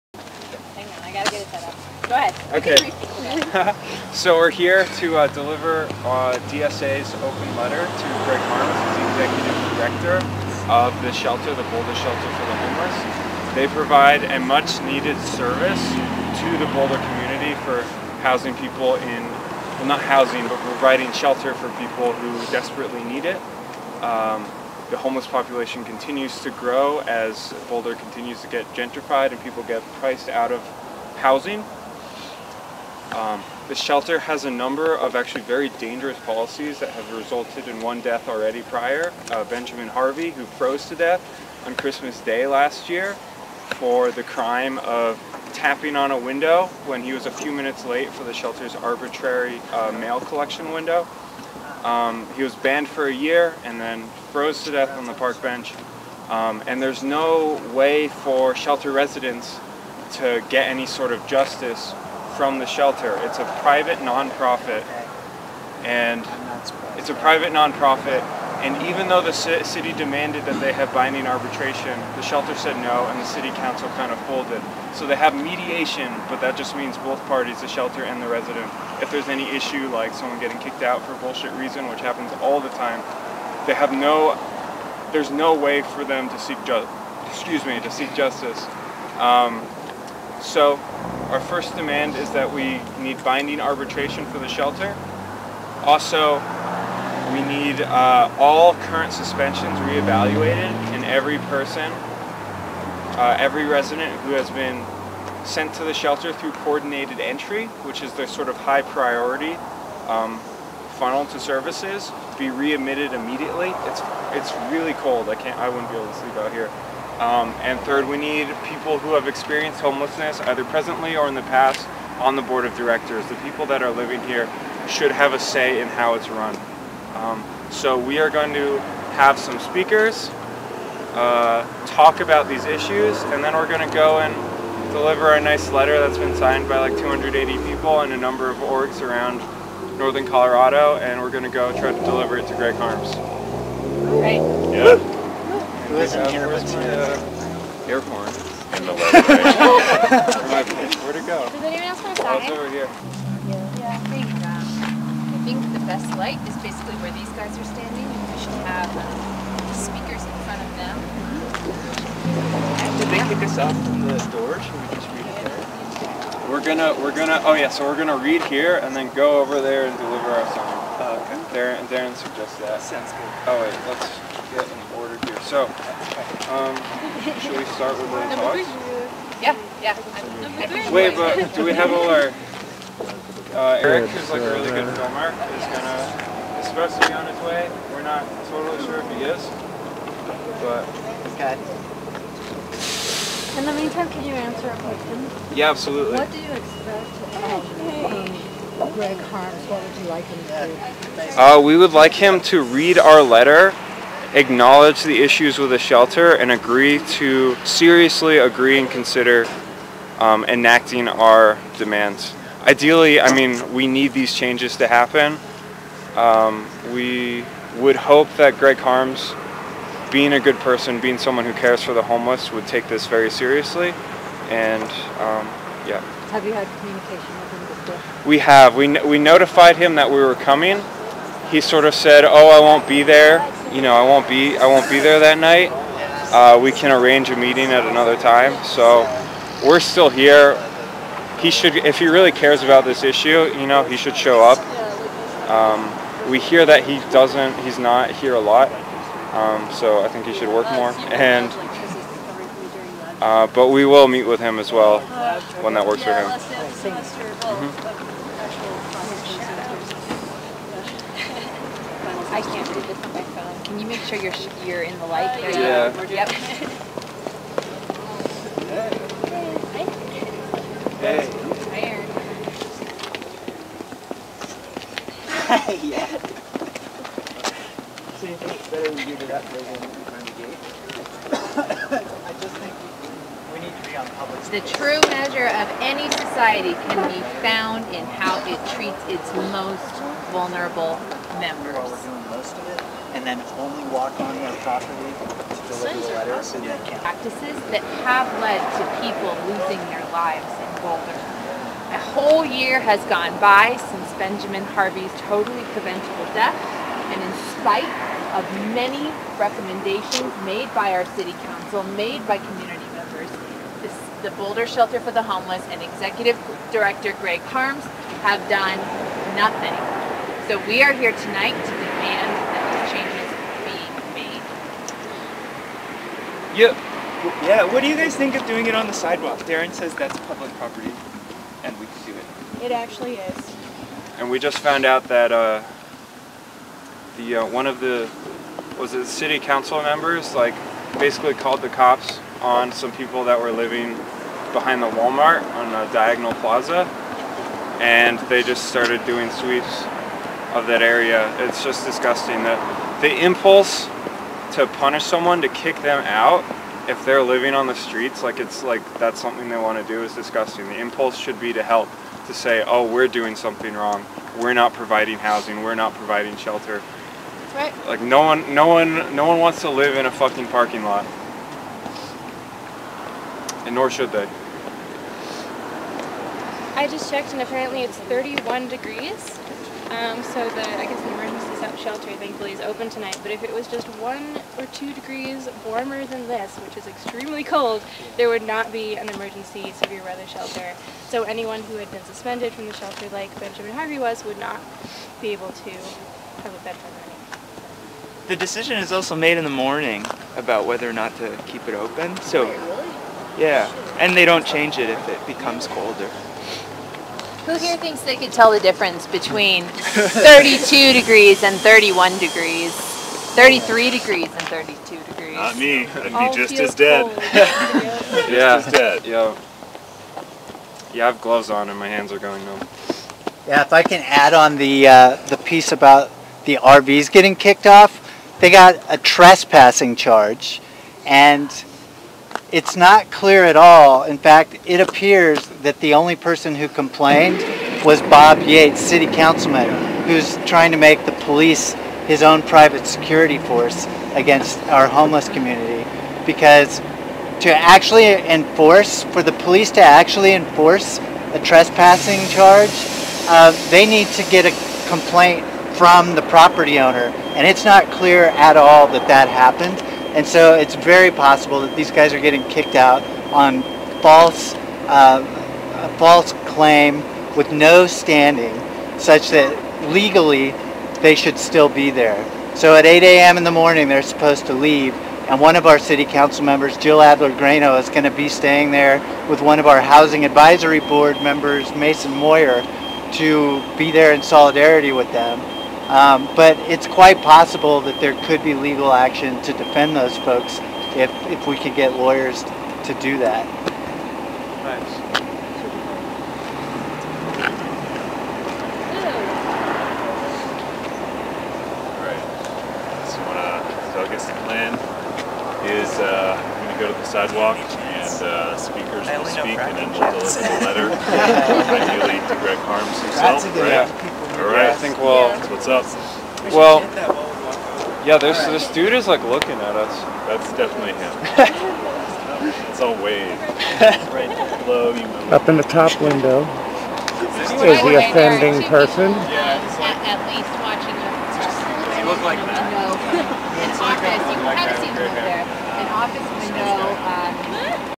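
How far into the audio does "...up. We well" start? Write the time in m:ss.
8:35.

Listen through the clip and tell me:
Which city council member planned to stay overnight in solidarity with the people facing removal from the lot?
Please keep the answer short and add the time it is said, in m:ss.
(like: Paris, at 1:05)
Jill Adler Grano, at 7:56.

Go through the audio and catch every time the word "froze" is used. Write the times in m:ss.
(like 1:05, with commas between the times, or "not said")
0:40, 0:54.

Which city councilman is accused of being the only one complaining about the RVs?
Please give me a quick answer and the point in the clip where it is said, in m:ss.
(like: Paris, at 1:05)
Bob Yates, at 7:18.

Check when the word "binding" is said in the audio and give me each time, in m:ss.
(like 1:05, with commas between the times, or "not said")
1:10, 1:33.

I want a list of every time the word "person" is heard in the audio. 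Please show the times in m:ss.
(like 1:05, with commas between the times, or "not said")
1:41, 3:40, 7:16, 8:48.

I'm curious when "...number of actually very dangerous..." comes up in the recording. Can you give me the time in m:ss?
0:34.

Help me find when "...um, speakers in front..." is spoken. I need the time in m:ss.
2:38.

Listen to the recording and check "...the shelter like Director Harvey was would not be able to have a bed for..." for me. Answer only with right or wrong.
wrong.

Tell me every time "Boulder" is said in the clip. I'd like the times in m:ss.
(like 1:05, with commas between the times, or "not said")
0:11, 0:16, 0:27, 5:00, 5:14.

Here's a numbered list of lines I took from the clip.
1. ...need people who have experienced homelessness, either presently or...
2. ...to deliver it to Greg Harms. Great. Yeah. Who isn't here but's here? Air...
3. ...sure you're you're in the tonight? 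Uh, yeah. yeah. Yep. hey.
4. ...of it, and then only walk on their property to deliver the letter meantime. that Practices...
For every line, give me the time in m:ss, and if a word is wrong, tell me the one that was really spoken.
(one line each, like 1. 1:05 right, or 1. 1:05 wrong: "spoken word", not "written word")
1. 1:58 right
2. 2:21 right
3. 4:24 wrong: "light", not "tonight"
4. 4:52 wrong: "awesome", not "meantime".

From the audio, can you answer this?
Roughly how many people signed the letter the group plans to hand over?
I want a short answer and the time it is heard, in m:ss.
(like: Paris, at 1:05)
280, at 2:16.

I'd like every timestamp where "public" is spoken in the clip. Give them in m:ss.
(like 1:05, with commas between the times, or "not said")
4:44, 5:30.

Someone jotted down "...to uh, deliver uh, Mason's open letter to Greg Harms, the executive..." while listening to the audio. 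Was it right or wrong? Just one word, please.
wrong.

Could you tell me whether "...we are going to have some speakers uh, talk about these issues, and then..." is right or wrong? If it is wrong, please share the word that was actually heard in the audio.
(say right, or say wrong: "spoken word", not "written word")
right.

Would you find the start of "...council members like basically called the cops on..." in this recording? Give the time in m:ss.
5:39.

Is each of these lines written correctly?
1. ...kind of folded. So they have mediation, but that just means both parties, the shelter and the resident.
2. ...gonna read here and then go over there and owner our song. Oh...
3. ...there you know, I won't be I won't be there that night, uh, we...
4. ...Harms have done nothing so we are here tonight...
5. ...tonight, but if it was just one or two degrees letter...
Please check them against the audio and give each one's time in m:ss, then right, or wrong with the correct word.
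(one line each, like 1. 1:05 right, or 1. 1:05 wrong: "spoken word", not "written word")
1. 1:13 right
2. 2:47 wrong: "deliver", not "owner"
3. 3:53 right
4. 5:17 right
5. 6:22 wrong: "warmer", not "letter".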